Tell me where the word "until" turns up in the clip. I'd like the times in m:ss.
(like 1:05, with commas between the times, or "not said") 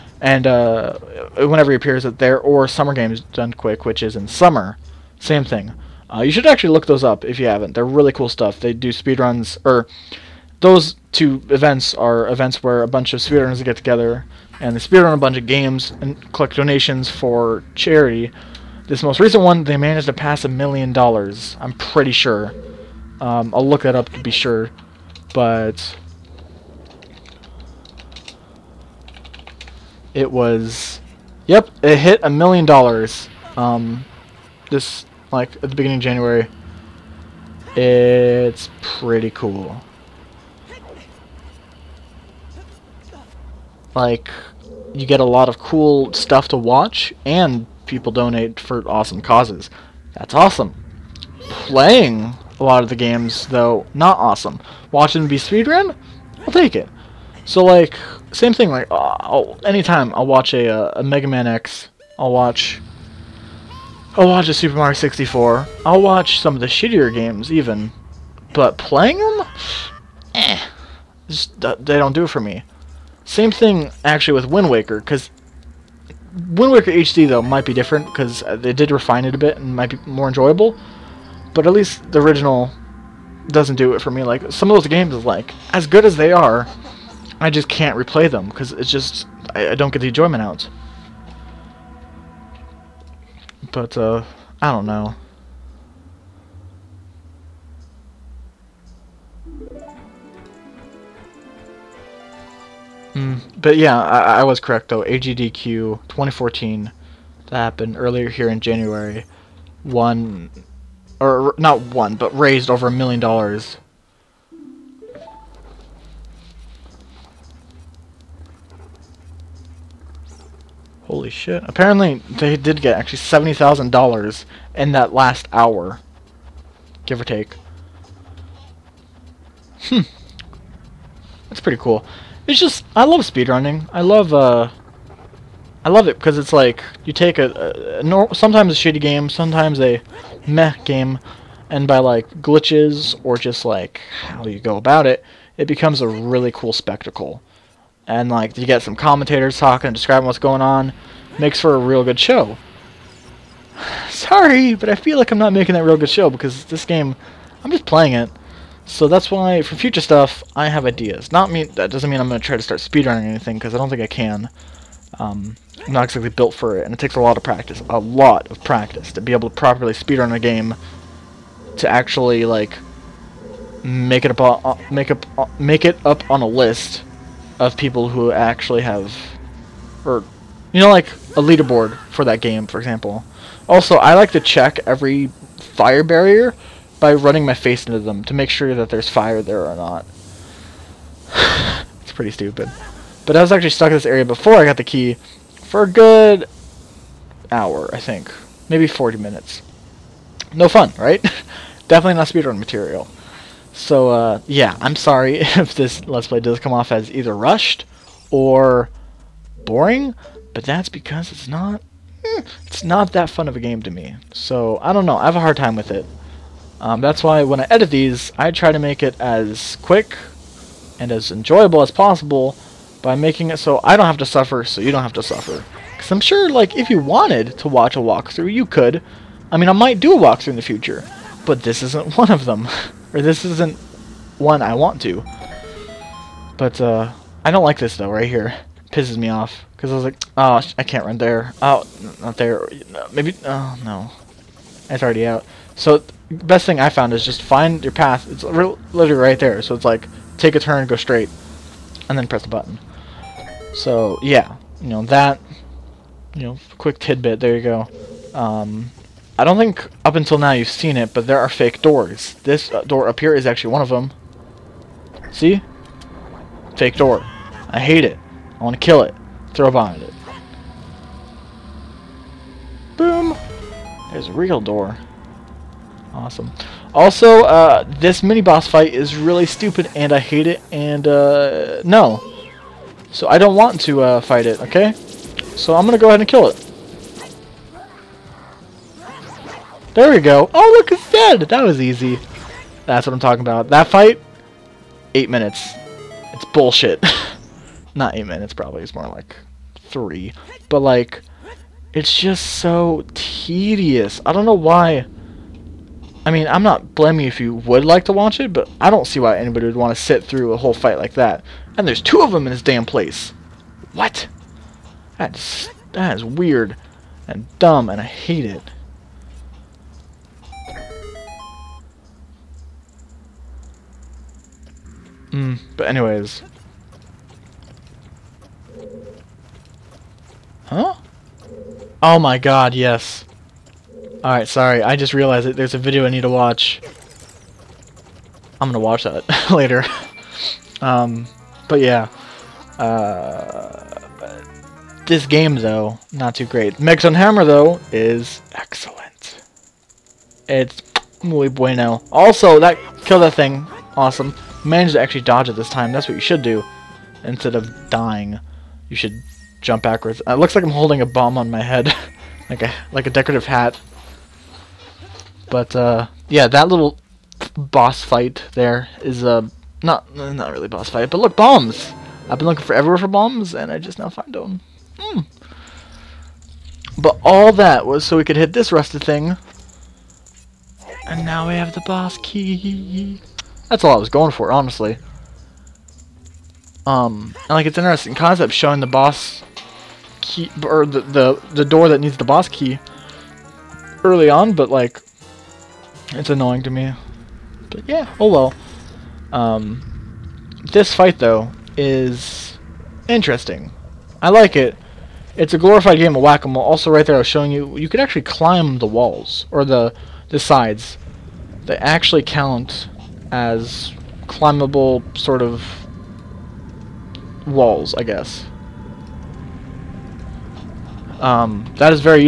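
4:20.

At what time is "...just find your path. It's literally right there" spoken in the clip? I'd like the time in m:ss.
4:07.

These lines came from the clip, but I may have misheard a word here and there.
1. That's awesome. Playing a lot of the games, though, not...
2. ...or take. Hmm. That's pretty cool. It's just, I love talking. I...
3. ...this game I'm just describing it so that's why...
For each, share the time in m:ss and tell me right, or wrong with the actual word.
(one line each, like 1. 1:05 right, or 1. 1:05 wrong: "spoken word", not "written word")
1. 0:50 right
2. 2:07 wrong: "speedrunning", not "talking"
3. 2:36 wrong: "playing", not "describing".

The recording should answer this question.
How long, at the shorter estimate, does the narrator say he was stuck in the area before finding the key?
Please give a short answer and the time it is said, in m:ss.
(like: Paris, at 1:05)
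40 minutes, at 3:18.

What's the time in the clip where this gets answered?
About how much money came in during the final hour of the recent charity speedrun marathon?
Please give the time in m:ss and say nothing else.
2:03.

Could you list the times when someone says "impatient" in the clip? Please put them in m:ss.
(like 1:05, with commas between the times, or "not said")
not said.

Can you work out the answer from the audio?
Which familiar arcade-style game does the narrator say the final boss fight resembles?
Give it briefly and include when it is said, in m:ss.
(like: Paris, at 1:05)
whack-a-mole, at 6:46.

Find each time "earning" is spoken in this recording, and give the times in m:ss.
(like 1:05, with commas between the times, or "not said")
not said.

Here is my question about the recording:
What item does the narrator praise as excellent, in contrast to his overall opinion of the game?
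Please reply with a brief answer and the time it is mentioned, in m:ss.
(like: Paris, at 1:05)
Megaton Hammer, at 5:46.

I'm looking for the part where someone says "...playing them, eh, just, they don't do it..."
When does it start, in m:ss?
1:08.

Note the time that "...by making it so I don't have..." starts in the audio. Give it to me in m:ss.
3:43.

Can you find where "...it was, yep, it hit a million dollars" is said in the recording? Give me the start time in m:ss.
0:30.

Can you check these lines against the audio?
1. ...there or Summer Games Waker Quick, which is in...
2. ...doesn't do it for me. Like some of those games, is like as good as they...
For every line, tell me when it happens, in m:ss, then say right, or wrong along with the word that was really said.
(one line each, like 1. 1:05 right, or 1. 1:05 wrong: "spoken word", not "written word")
1. 0:02 wrong: "Done", not "Waker"
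2. 1:23 right.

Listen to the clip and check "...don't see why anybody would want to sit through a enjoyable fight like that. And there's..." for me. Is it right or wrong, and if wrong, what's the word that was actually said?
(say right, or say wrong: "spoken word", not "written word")
wrong: "whole", not "enjoyable".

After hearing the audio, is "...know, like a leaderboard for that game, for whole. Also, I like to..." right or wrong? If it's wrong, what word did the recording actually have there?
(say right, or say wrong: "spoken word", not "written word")
wrong: "example", not "whole".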